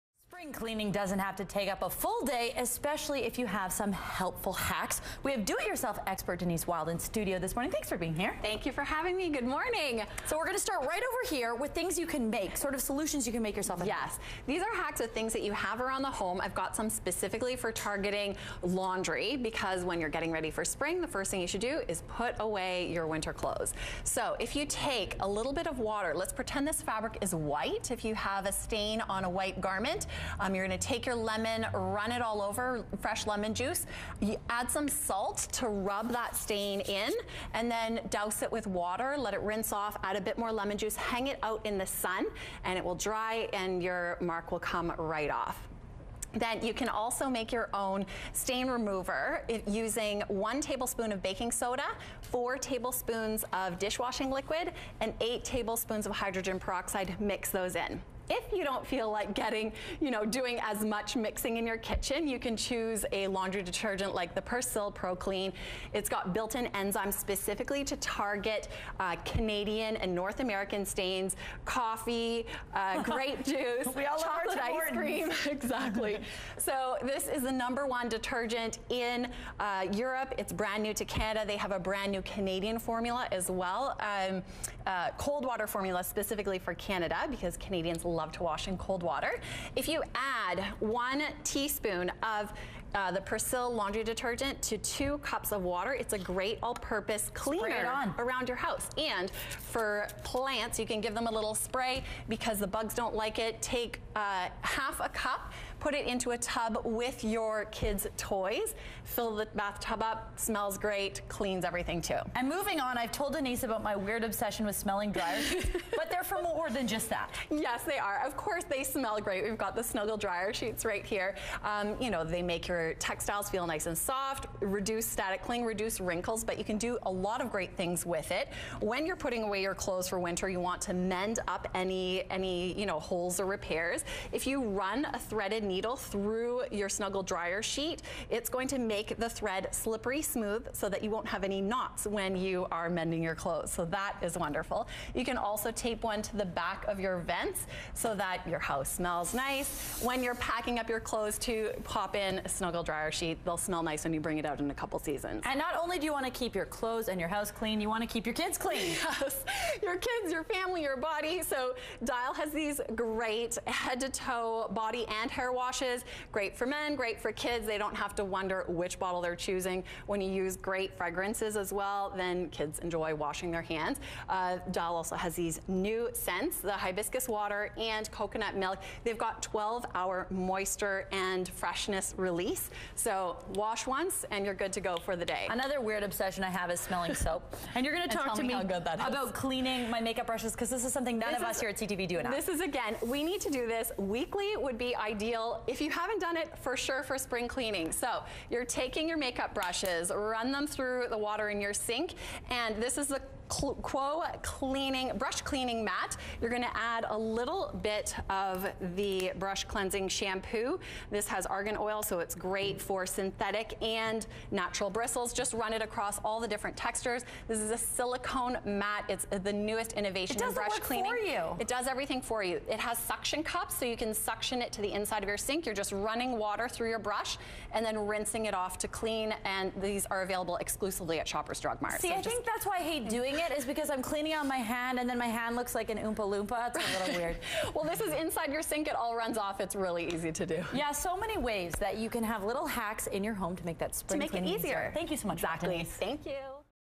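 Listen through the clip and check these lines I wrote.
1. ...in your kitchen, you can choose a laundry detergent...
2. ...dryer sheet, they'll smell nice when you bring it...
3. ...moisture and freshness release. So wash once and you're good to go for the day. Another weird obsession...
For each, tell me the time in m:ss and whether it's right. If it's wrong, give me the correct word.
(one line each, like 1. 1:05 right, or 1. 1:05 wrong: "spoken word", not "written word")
1. 1:01 right
2. 2:32 right
3. 3:00 right.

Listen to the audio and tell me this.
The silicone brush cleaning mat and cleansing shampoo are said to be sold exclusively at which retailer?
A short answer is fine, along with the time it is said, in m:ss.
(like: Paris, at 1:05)
Shoppers Drug Mart, at 3:51.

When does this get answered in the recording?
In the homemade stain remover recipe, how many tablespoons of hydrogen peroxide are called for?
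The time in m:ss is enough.
0:55.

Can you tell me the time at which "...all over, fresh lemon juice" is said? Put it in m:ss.
0:32.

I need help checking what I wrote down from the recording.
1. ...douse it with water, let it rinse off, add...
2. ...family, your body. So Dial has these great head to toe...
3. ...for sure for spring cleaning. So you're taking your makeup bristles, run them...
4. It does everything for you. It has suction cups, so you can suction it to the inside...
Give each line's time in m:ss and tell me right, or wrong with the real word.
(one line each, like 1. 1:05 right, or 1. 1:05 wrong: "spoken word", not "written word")
1. 0:38 right
2. 2:40 right
3. 3:16 wrong: "brushes", not "bristles"
4. 3:41 right.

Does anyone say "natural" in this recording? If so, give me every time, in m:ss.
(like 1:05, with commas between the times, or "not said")
3:34.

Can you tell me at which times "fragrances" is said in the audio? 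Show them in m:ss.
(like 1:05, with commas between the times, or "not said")
2:50.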